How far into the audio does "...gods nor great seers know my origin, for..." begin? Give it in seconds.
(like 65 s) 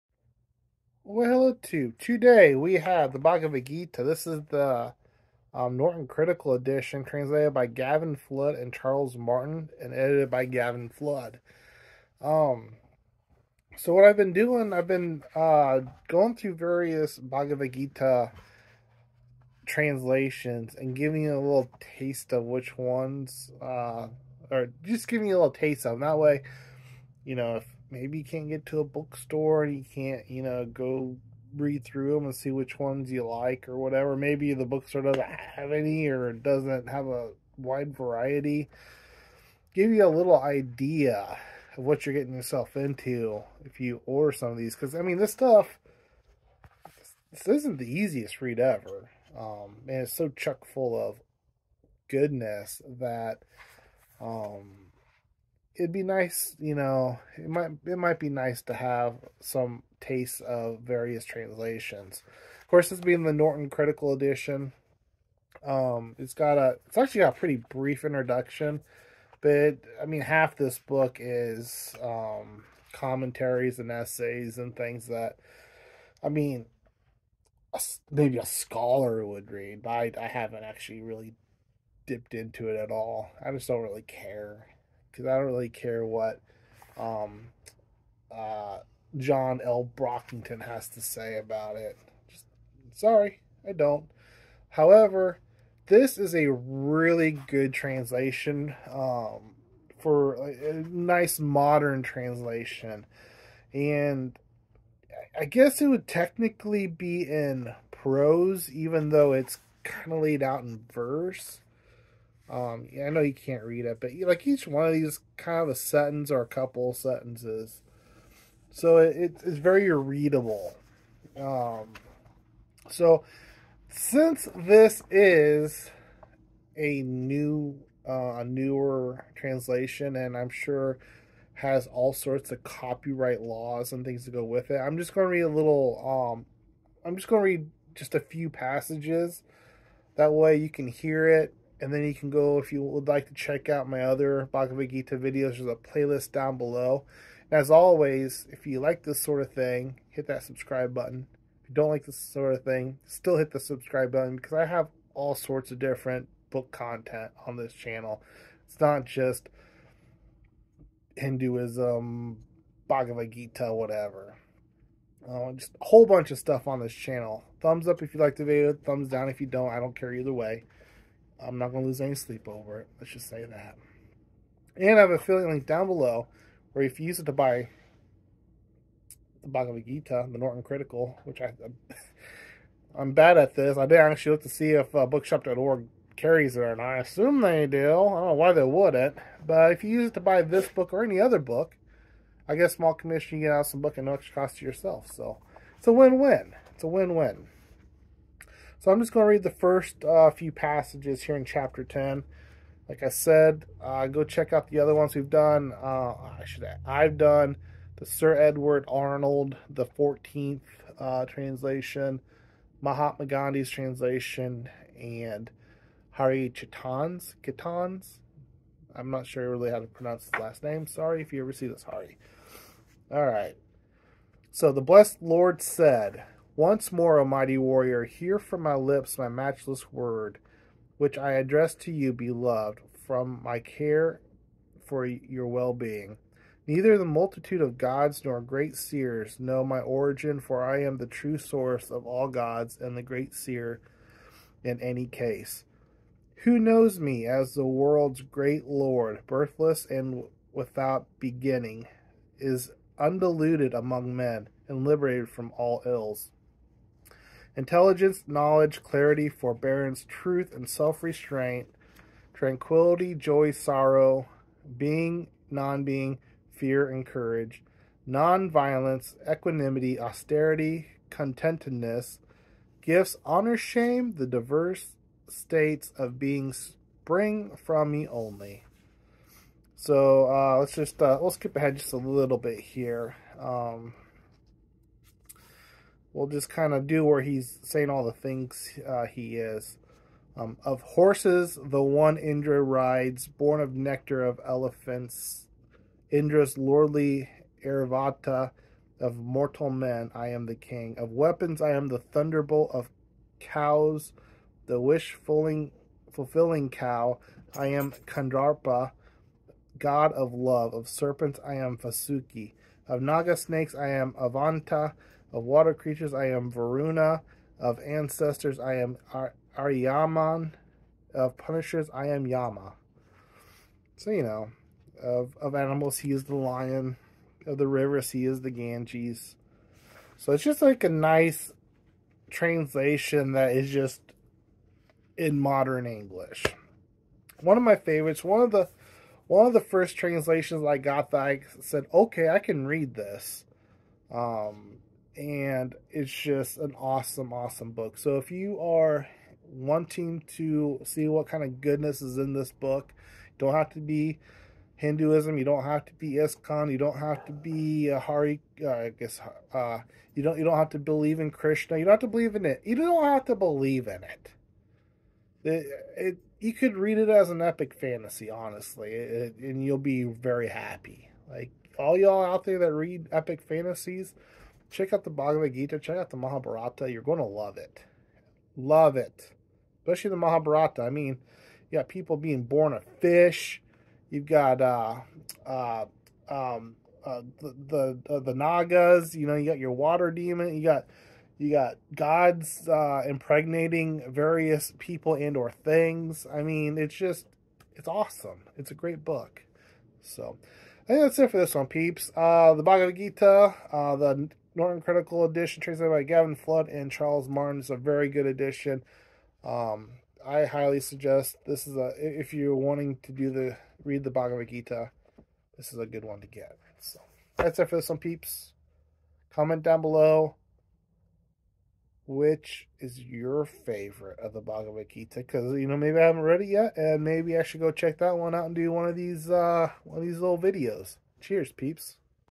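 237 s.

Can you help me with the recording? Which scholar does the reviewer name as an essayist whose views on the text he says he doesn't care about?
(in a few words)
John L. Brockington.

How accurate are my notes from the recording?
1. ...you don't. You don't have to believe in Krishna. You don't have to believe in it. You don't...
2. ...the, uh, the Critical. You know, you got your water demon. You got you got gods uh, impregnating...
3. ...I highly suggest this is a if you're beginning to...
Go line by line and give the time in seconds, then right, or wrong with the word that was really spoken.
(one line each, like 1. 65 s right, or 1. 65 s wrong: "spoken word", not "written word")
1. 360 s right
2. 388 s wrong: "Nagas", not "Critical"
3. 410 s wrong: "wanting", not "beginning".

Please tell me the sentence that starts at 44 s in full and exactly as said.
Because, I mean, this stuff, this isn't the easiest read ever.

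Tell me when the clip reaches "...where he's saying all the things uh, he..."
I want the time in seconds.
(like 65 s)
287 s.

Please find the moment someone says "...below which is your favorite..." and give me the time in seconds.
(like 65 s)
419 s.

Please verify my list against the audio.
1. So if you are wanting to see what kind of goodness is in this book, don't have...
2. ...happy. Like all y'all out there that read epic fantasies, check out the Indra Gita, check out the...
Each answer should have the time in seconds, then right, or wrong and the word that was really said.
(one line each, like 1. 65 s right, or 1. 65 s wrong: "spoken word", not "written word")
1. 347 s right
2. 370 s wrong: "Bhagavad", not "Indra".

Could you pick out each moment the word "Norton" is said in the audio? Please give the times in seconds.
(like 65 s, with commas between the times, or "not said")
5 s, 63 s, 180 s, 404 s.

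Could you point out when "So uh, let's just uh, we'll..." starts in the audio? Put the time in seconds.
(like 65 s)
279 s.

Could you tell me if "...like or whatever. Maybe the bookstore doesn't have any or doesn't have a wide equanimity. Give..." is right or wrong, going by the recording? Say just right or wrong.
wrong.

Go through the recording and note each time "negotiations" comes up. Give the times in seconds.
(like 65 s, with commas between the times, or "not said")
not said.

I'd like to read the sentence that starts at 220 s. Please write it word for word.
Sorry if you ever see this, Hari.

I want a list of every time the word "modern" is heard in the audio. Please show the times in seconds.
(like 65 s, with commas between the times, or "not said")
101 s, 335 s.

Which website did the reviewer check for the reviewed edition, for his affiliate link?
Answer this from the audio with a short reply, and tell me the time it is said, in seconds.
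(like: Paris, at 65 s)
bookshop.org, at 185 s.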